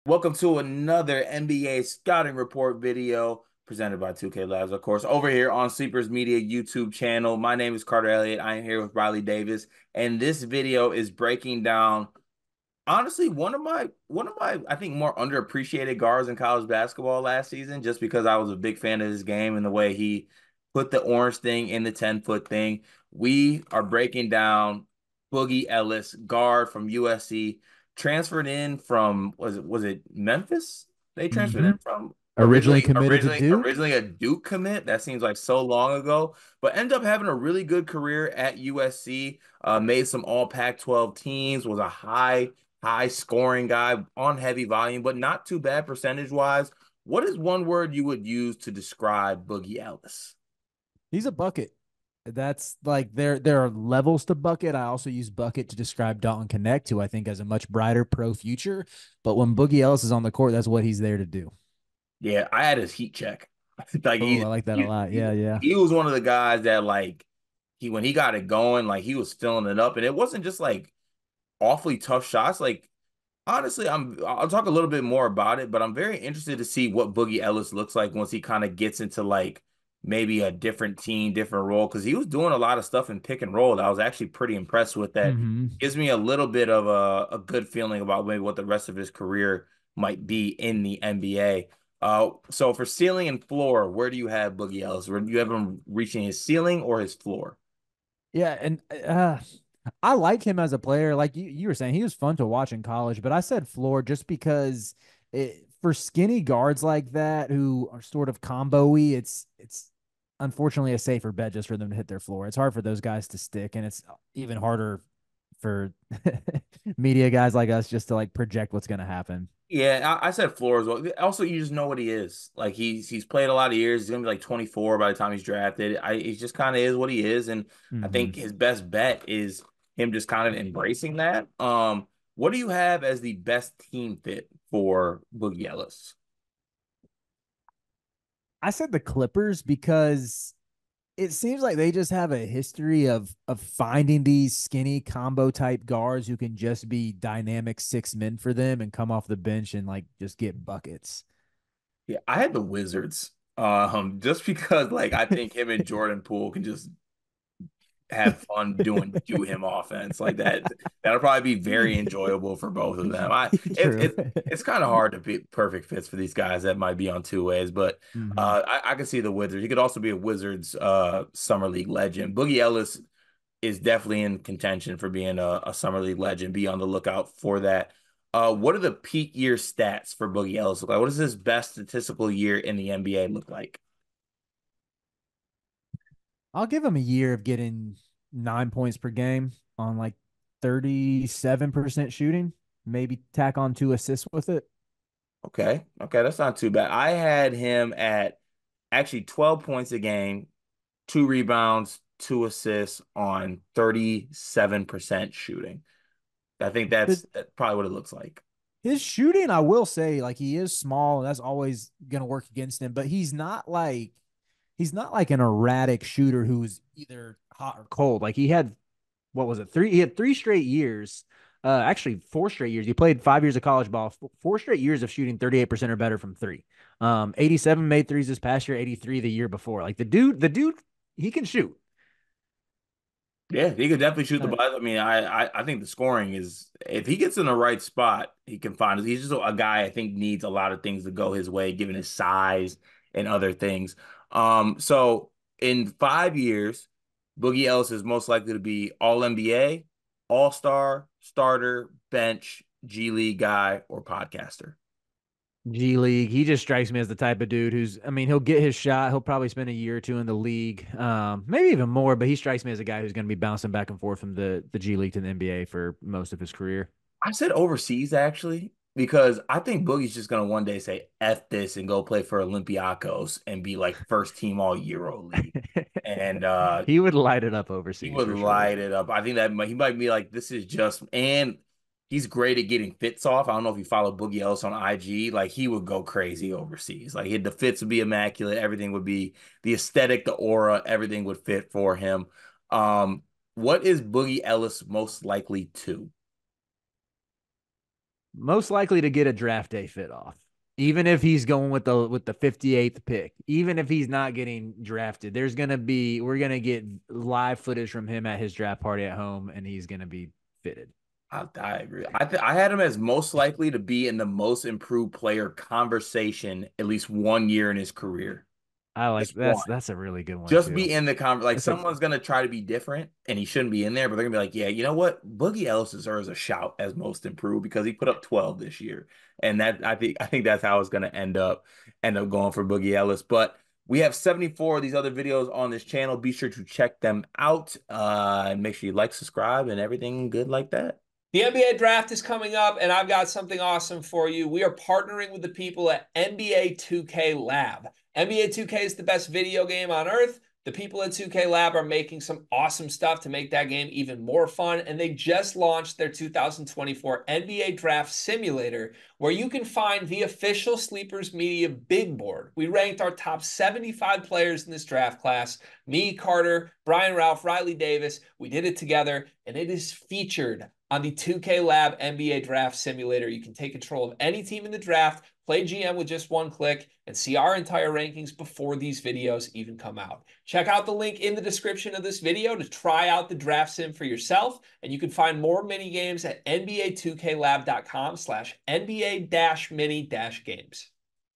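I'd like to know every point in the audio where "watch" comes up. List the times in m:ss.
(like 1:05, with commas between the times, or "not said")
1:42.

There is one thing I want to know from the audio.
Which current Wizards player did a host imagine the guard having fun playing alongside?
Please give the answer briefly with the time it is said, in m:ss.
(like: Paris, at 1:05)
Jordan Poole, at 2:35.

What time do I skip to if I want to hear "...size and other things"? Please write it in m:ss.
4:02.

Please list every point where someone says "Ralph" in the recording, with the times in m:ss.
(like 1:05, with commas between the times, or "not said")
6:07.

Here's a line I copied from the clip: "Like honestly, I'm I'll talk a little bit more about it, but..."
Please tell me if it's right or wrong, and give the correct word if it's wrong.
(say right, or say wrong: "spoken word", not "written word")
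right.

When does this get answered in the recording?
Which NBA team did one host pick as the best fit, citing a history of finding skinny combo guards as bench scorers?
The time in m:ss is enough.
2:18.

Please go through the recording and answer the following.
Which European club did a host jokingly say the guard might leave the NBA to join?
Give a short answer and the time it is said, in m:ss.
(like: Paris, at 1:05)
Olympiacos, at 4:32.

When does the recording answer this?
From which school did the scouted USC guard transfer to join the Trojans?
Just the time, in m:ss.
0:30.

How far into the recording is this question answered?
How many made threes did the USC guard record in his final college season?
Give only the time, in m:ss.
3:47.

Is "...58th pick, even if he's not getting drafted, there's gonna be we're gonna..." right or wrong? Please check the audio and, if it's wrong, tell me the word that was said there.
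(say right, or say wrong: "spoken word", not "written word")
right.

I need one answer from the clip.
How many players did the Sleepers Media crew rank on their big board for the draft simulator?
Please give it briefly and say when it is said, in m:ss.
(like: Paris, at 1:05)
75, at 6:03.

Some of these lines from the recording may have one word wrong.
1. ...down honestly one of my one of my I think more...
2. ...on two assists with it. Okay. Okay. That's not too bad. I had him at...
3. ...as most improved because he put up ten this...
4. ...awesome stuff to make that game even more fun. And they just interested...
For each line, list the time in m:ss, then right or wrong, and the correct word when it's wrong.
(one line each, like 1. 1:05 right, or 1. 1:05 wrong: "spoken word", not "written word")
1. 0:11 right
2. 3:13 right
3. 5:26 wrong: "twelve", not "ten"
4. 5:52 wrong: "launched", not "interested".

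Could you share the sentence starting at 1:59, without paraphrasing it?
Yeah, I, I, said floor as well.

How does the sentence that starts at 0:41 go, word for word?
Was a high high scoring guy on heavy volume, but not too bad percentage wise.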